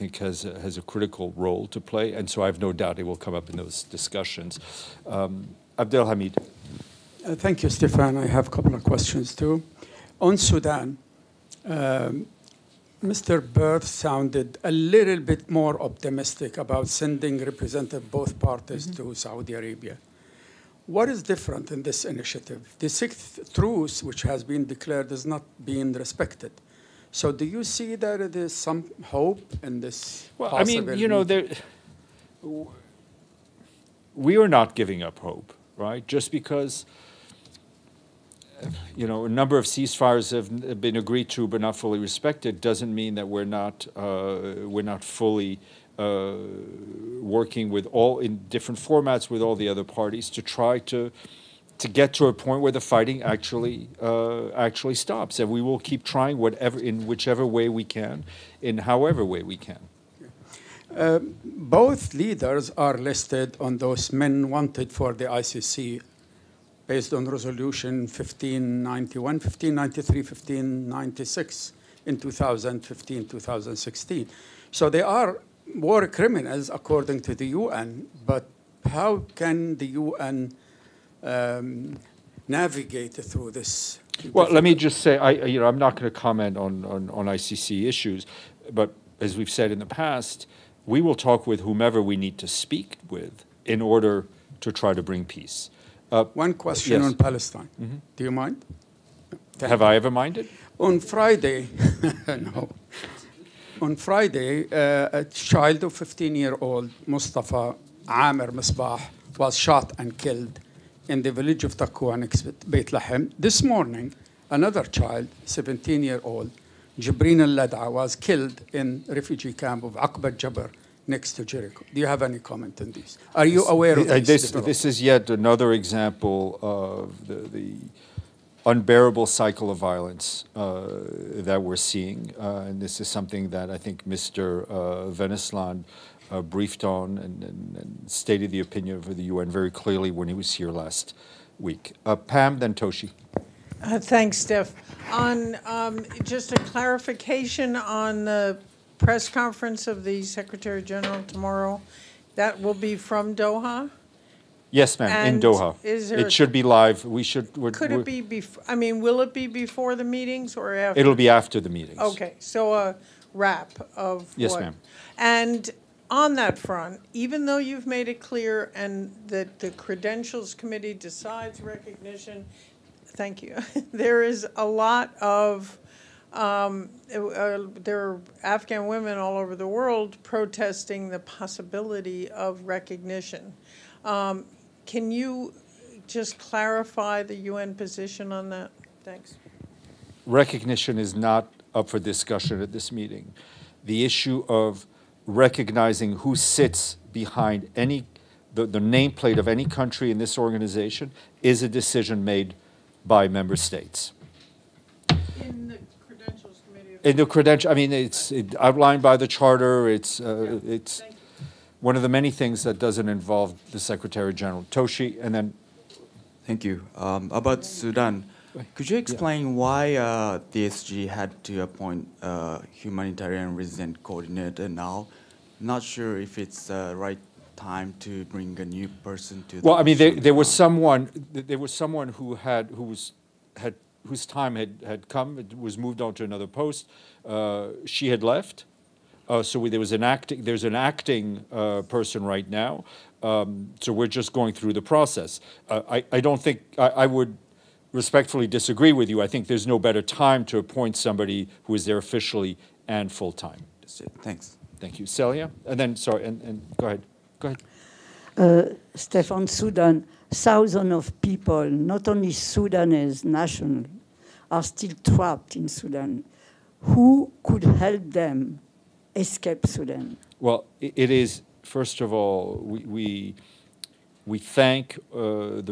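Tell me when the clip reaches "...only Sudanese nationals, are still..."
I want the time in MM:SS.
04:22.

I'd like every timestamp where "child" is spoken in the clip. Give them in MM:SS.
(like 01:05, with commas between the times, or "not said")
01:45, 01:54.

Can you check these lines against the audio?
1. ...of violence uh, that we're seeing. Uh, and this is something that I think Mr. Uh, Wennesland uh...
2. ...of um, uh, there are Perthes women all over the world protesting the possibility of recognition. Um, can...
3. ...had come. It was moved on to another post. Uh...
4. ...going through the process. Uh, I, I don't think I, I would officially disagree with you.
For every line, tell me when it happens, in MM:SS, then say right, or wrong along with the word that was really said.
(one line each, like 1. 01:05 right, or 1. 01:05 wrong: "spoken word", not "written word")
1. 02:09 right
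2. 02:55 wrong: "Afghan", not "Perthes"
3. 03:54 right
4. 04:04 wrong: "respectfully", not "officially".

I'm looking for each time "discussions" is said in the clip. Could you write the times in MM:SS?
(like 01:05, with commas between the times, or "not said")
00:03, 03:11.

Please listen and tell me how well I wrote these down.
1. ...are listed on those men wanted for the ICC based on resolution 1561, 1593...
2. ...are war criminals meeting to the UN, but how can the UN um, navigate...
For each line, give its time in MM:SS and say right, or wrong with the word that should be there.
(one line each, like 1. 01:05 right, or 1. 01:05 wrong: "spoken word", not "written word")
1. 01:02 wrong: "1591", not "1561"
2. 01:15 wrong: "according", not "meeting".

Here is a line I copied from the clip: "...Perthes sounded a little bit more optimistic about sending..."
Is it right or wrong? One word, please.
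right.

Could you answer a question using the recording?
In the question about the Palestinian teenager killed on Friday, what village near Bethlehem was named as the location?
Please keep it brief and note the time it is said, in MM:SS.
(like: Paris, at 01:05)
Takwa, at 01:51.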